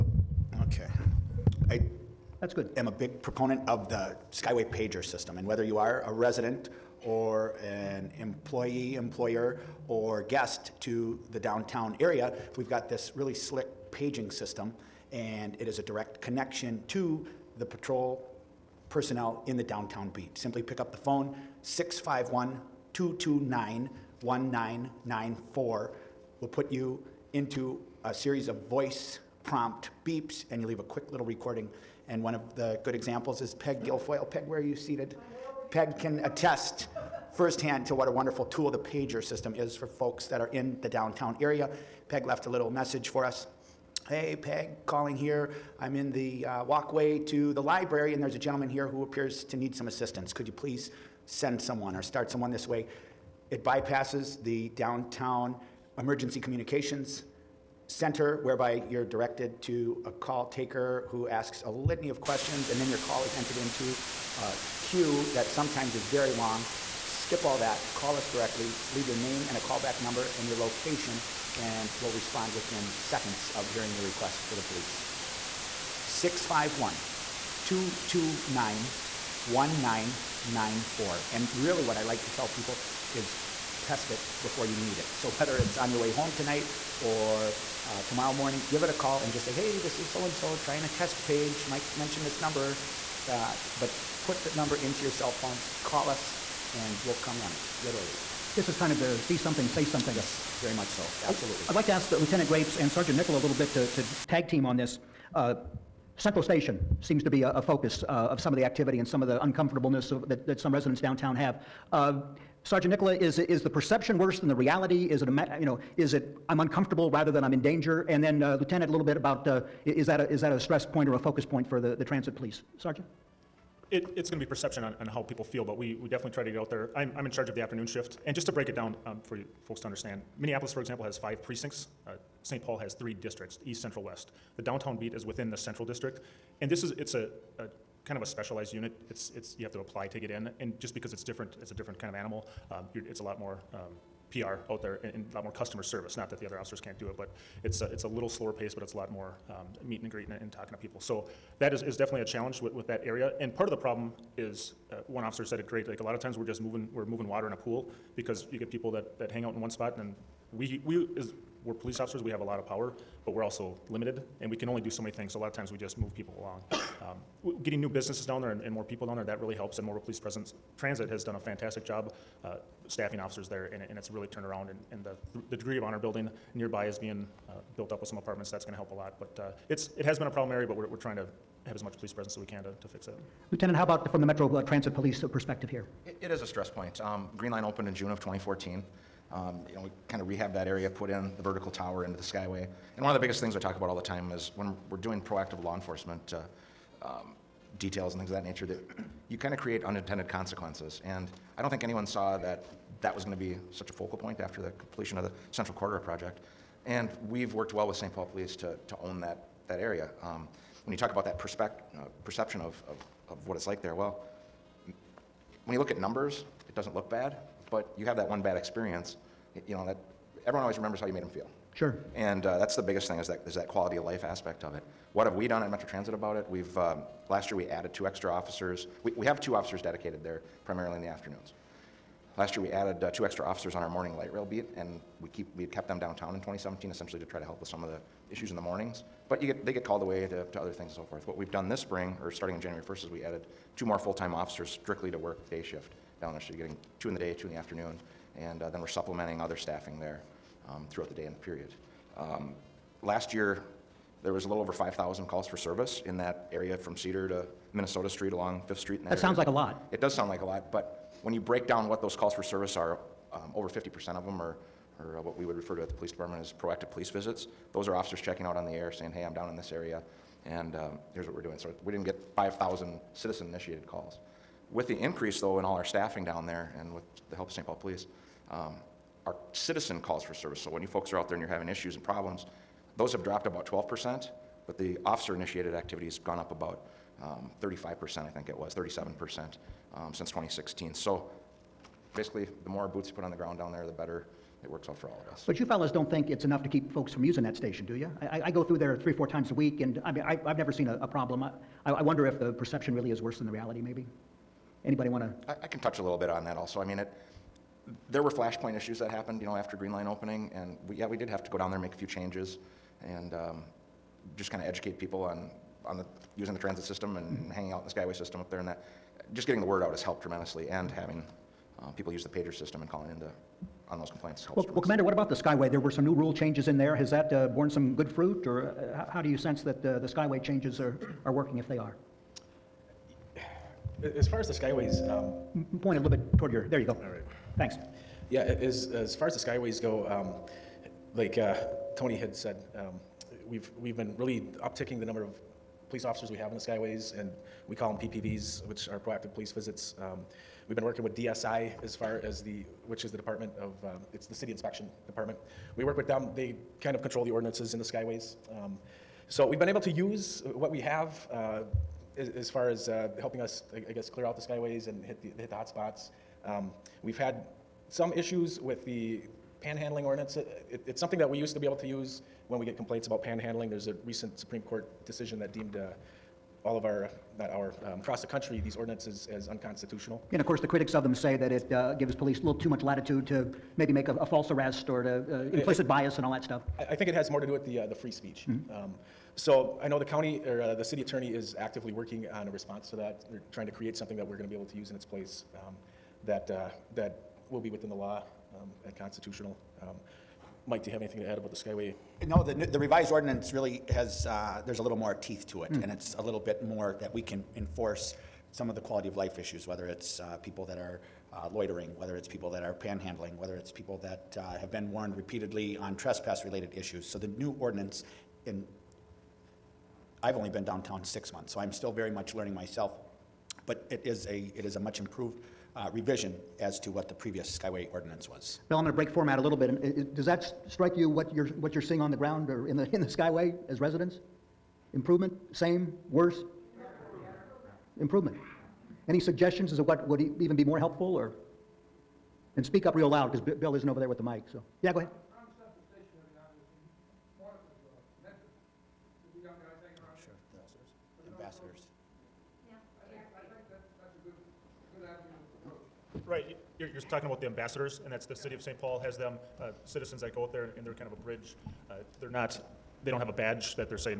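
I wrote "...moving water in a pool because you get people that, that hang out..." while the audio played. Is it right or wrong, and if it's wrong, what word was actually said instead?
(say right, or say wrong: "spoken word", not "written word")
right.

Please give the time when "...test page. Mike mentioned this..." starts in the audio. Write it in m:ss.
1:30.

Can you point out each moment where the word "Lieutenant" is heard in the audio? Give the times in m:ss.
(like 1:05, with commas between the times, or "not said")
1:42, 1:58, 3:03.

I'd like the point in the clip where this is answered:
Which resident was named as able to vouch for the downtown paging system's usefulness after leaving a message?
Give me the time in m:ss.
0:33.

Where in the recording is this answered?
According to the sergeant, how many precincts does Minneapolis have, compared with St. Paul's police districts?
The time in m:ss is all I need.
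2:11.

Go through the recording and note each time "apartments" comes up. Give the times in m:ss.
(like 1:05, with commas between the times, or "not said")
2:58.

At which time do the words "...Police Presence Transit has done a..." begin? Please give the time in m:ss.
2:50.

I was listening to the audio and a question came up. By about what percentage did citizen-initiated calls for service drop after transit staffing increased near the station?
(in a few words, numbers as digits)
12%.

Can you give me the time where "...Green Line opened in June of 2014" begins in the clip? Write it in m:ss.
3:07.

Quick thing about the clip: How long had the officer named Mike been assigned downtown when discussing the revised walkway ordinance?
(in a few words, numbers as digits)
6 months.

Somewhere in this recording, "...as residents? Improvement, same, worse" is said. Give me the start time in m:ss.
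7:13.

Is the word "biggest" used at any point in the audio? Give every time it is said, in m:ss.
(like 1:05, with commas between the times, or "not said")
3:13, 3:42.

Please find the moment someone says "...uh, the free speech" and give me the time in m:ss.
6:27.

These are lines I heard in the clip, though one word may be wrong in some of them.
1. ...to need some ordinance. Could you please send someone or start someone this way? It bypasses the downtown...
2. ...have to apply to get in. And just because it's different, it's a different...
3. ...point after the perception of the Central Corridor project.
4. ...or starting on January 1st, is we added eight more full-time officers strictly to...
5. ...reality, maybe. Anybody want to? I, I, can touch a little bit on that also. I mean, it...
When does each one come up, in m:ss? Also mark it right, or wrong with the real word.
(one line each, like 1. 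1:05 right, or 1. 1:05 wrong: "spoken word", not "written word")
1. 0:49 wrong: "assistance", not "ordinance"
2. 2:19 right
3. 3:24 wrong: "completion", not "perception"
4. 4:02 wrong: "two", not "eight"
5. 5:03 right.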